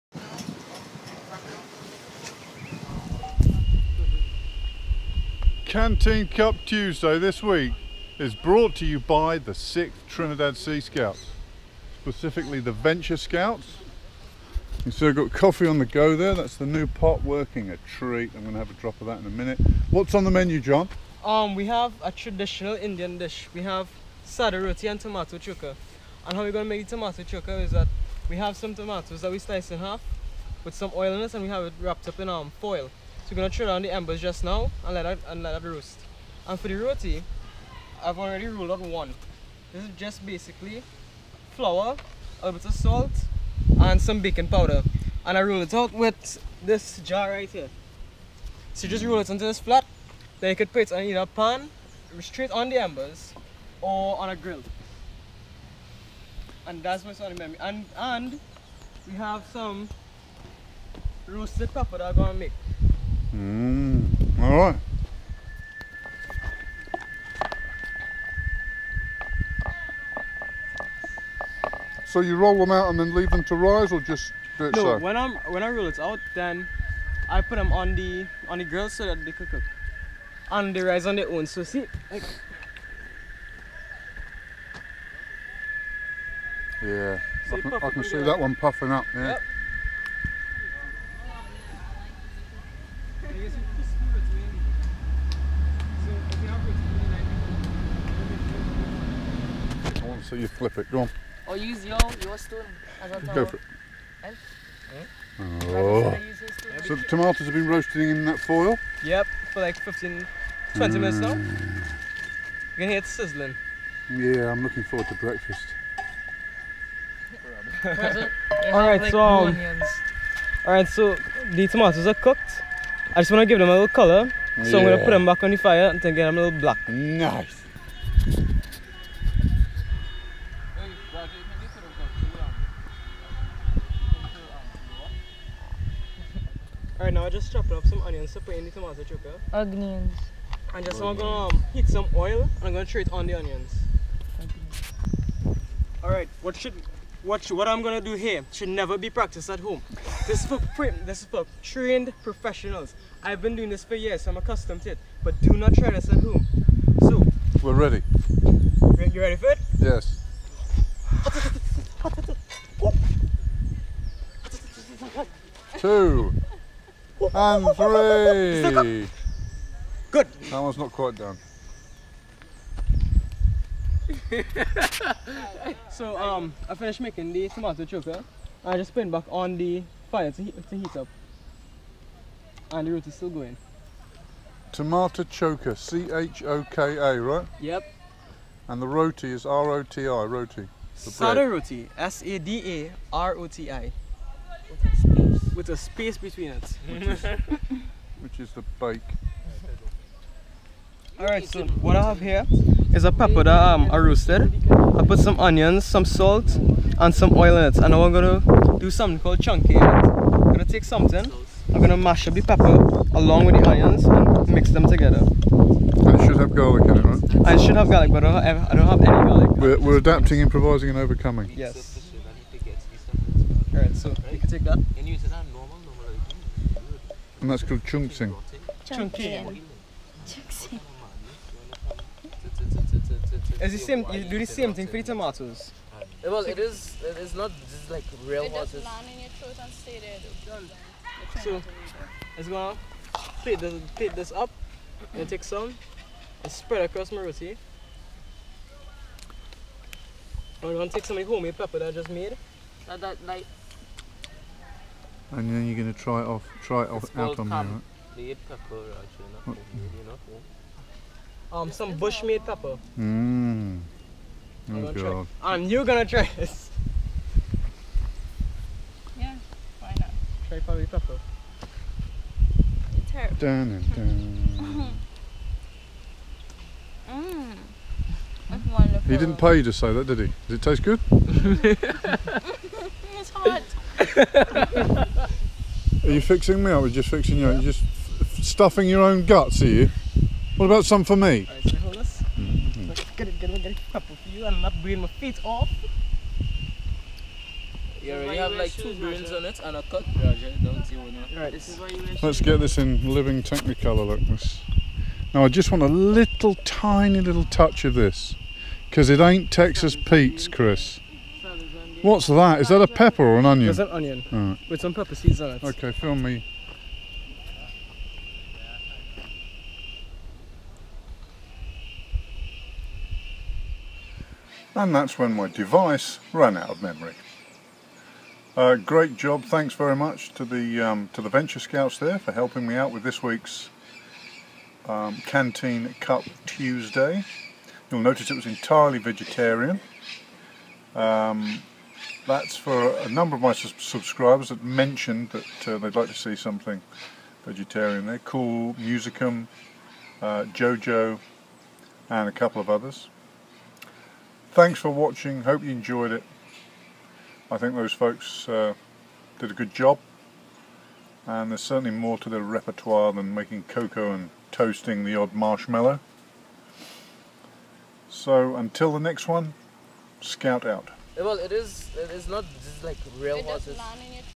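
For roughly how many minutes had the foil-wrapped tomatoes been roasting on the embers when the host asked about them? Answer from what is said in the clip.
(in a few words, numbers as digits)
15 to 20 minutes.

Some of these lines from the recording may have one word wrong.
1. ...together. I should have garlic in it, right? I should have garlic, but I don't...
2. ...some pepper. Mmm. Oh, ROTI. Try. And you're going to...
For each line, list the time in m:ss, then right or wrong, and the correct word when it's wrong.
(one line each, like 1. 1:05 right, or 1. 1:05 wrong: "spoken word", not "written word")
1. 3:34 right
2. 4:21 wrong: "God", not "ROTI".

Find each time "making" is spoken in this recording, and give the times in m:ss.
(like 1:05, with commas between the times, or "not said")
2:56, 6:03.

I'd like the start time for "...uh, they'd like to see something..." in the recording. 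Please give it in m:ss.
5:45.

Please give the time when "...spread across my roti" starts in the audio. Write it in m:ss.
4:06.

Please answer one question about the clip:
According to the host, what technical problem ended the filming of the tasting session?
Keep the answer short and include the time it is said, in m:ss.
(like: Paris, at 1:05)
Device ran out of memory, at 5:25.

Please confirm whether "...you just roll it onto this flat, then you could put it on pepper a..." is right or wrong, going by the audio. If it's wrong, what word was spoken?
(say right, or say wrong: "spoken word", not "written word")
wrong: "either", not "pepper".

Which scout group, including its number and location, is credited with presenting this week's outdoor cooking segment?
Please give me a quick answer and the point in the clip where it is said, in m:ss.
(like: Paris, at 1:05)
6th Trinidad Sea Scouts, at 0:09.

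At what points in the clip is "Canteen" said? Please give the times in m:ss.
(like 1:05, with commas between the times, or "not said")
0:05, 5:35.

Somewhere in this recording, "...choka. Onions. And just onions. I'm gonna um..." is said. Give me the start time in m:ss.
2:19.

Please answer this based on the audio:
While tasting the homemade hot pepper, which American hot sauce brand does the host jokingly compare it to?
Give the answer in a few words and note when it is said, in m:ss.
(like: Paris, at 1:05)
Texas Pete's, at 5:09.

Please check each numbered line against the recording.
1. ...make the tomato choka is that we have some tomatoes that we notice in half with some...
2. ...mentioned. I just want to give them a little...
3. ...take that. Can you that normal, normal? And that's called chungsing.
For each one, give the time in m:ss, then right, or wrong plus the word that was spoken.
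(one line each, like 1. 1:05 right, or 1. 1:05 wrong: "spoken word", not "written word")
1. 0:26 wrong: "slice", not "notice"
2. 2:02 wrong: "cooked", not "mentioned"
3. 3:44 right.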